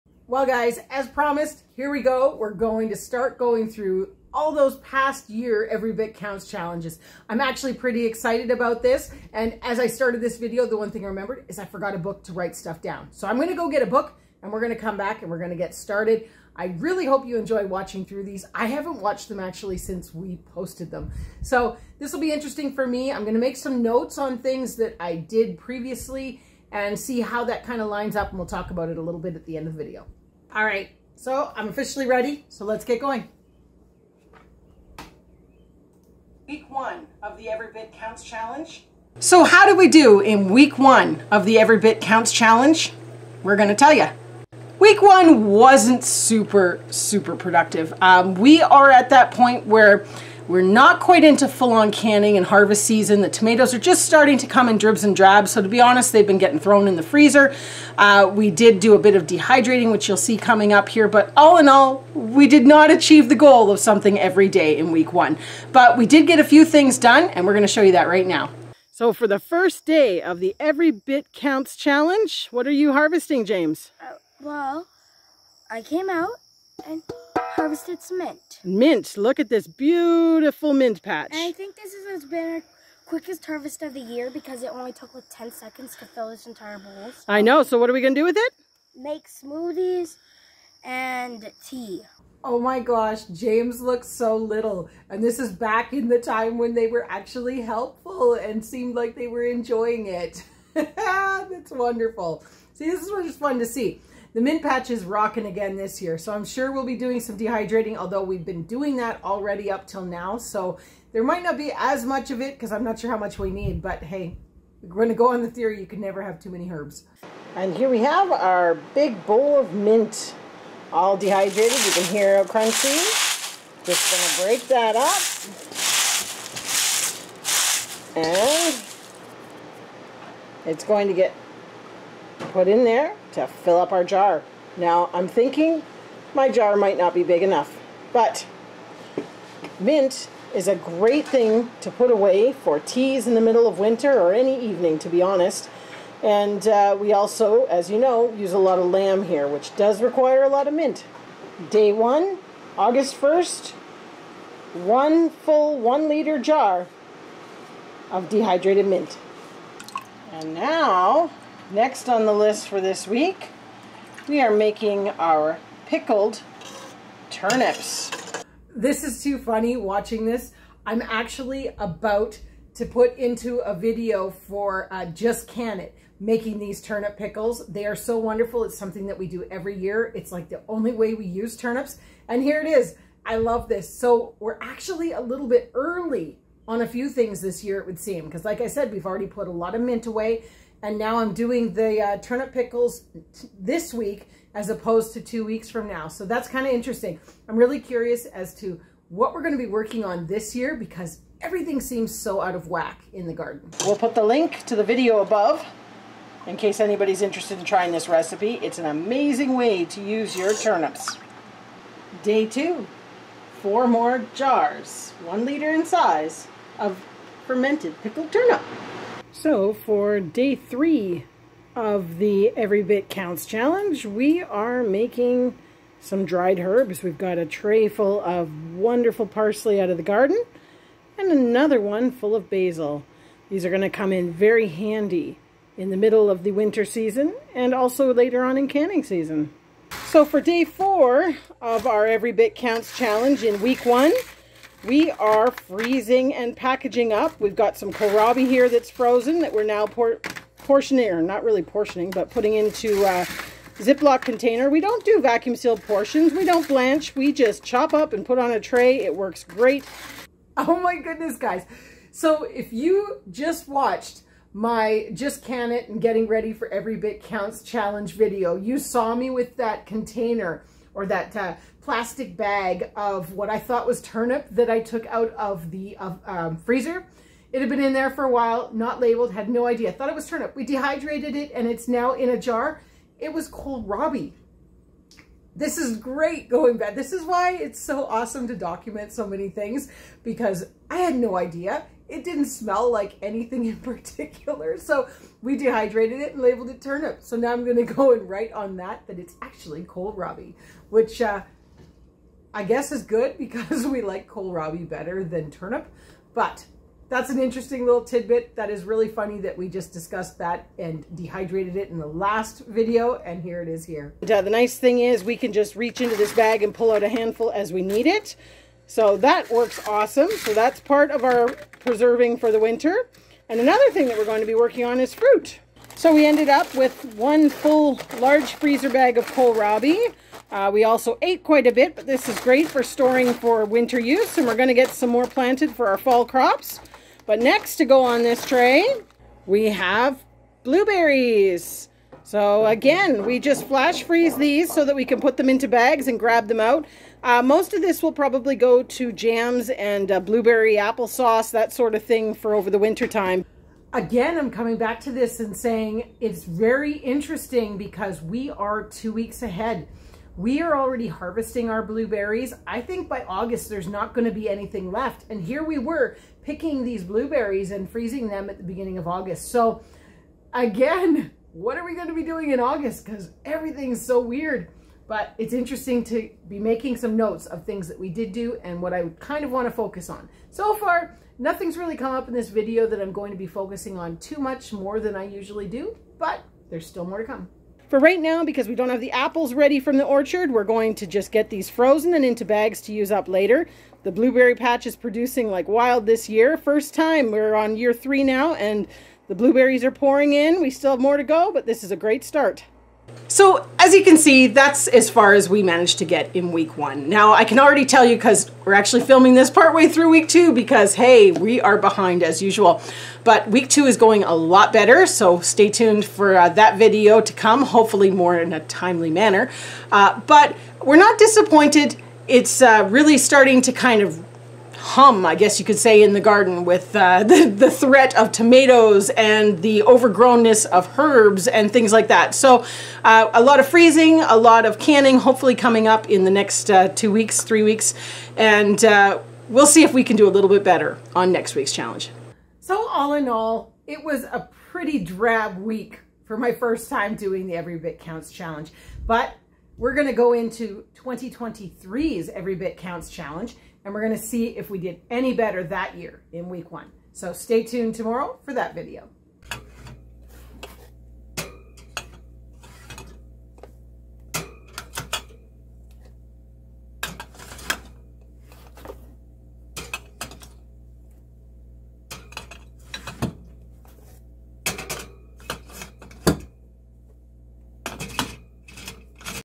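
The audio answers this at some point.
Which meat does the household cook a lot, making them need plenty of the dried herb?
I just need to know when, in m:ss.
2:28.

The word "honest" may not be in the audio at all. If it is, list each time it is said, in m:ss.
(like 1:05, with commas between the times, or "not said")
0:55, 2:25.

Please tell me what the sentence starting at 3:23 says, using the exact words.
We'll put the link to the video above in case anybody's interested in trying this recipe.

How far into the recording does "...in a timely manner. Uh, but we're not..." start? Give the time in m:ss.
6:58.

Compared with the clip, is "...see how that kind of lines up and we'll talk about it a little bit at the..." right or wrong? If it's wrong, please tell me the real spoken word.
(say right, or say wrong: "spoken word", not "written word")
right.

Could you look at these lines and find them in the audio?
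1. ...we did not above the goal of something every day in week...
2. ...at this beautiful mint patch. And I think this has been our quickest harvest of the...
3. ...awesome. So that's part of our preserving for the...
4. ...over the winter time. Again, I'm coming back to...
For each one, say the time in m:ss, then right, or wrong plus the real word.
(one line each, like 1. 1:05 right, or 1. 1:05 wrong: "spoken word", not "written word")
1. 1:02 wrong: "achieve", not "above"
2. 1:19 right
3. 5:19 right
4. 5:52 right.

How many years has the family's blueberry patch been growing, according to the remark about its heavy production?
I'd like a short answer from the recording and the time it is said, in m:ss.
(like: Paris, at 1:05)
3, at 6:37.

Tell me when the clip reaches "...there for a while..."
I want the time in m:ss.
4:37.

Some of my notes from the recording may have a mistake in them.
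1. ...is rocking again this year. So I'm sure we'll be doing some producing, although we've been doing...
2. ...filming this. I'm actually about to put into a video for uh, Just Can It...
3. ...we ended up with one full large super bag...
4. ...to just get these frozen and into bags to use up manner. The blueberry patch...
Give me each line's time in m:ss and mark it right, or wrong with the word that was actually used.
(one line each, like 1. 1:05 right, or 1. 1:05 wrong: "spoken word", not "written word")
1. 1:44 wrong: "dehydrating", not "producing"
2. 2:49 wrong: "watching", not "filming"
3. 5:26 wrong: "freezer", not "super"
4. 6:30 wrong: "later", not "manner".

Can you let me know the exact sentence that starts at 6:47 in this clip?
Now I can already tell you because we're actually filming this partway through week two because hey, we are behind as usual.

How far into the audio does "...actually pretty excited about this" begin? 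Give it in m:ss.
0:07.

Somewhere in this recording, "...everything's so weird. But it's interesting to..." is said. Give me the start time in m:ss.
6:13.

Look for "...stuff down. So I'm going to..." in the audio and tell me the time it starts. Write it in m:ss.
0:12.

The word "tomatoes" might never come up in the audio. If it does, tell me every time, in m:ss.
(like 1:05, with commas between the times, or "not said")
0:53, 7:08.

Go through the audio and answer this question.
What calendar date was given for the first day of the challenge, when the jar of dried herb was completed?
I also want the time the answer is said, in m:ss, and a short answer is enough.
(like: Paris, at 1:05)
August 1st, at 2:32.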